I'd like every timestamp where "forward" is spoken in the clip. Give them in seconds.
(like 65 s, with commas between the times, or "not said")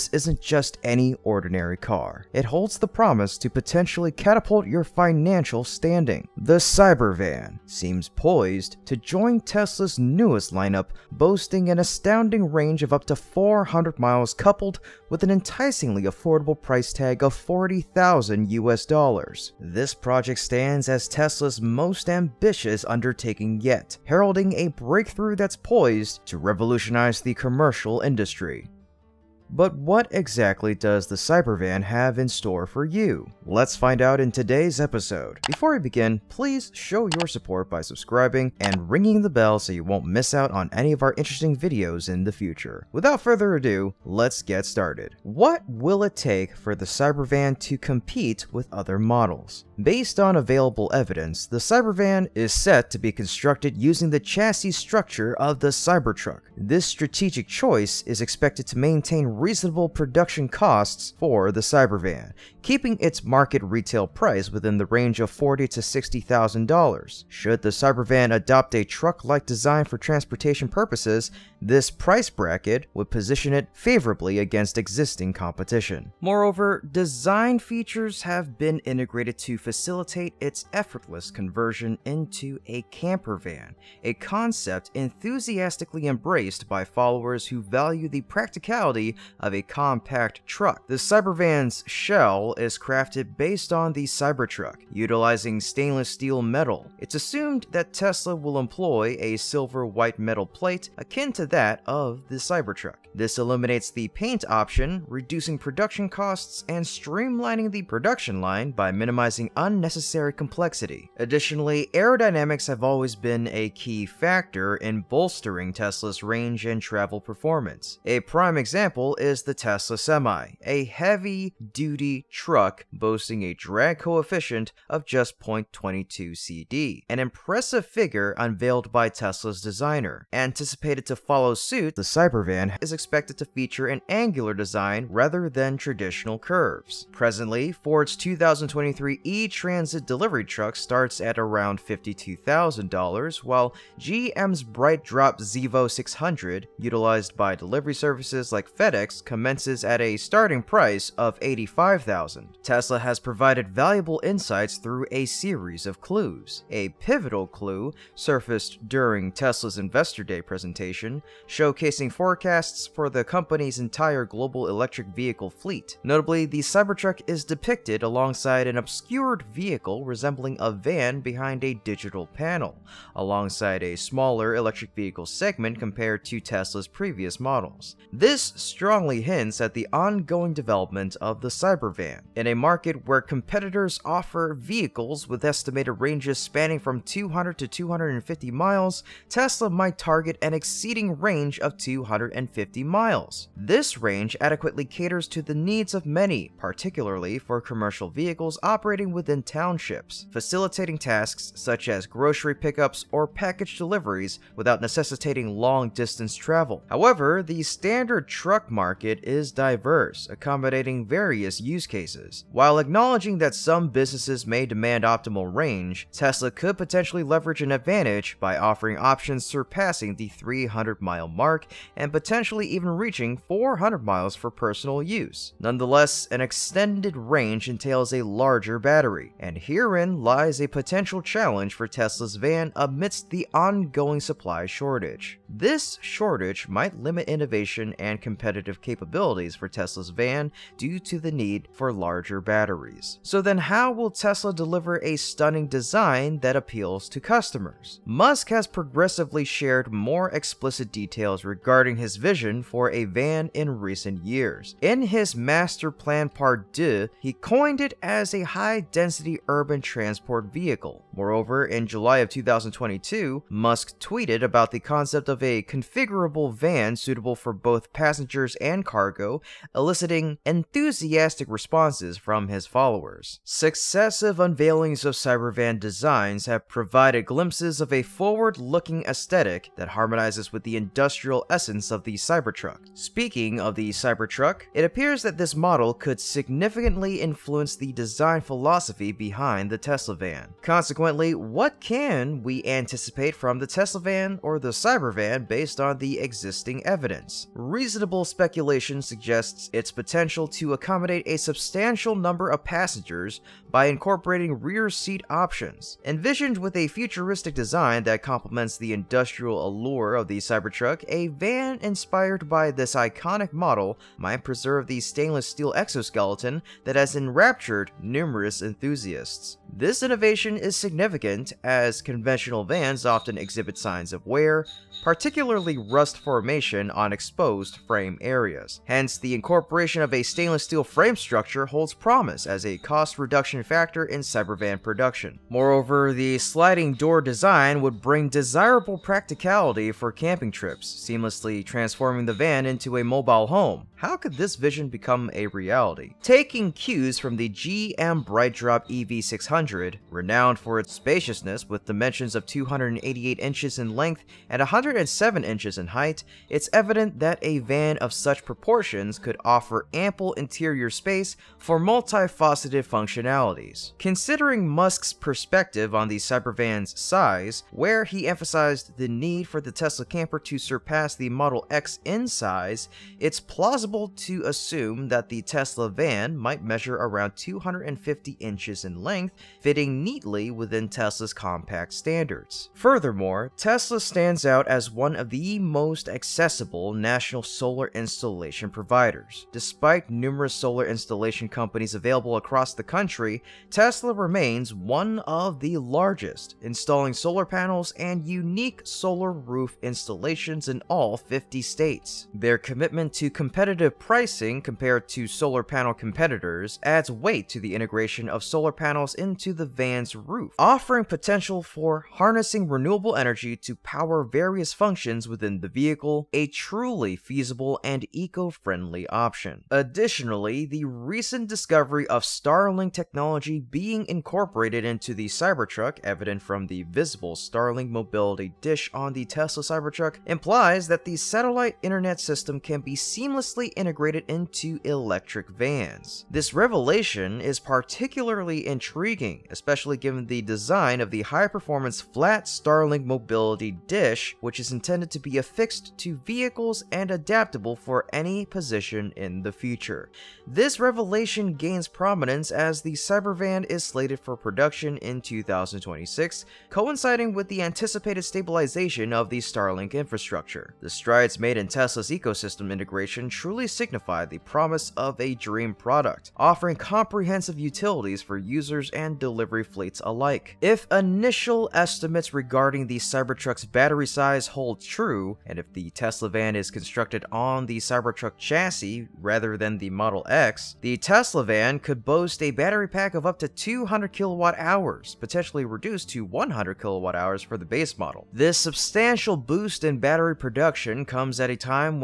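278 s.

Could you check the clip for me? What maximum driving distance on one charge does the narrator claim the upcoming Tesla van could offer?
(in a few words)
400 miles.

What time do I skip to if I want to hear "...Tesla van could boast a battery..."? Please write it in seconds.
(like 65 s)
480 s.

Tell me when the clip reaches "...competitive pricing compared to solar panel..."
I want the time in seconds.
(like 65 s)
403 s.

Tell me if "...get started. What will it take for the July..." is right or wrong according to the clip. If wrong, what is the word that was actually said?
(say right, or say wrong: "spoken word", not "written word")
wrong: "Cybervan", not "July".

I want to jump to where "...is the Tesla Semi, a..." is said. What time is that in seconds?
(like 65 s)
119 s.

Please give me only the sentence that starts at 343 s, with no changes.
How could this vision become a reality?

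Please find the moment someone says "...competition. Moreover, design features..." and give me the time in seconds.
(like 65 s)
75 s.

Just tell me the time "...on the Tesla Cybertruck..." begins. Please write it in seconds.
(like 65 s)
428 s.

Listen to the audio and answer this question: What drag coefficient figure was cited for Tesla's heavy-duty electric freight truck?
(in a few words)
0.22.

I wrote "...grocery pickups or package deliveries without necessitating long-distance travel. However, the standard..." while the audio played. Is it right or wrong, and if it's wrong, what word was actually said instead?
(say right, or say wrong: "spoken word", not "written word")
right.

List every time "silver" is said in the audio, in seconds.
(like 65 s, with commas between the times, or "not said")
99 s.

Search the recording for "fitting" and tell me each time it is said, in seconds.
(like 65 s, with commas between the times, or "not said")
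379 s.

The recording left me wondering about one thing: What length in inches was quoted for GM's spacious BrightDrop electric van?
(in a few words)
288 inches.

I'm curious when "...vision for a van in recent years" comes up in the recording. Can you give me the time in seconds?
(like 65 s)
252 s.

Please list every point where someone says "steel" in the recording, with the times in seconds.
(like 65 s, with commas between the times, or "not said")
96 s, 315 s, 330 s.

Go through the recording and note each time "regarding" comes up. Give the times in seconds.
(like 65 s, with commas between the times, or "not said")
251 s, 472 s.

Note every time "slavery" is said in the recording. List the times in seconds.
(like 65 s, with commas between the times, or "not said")
not said.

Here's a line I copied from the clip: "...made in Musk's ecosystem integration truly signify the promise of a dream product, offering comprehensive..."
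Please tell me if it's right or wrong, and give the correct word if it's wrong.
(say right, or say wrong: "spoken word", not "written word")
wrong: "Tesla", not "Musk".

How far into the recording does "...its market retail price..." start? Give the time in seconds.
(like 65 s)
62 s.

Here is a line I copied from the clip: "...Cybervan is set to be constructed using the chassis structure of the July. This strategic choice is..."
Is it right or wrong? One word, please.
wrong.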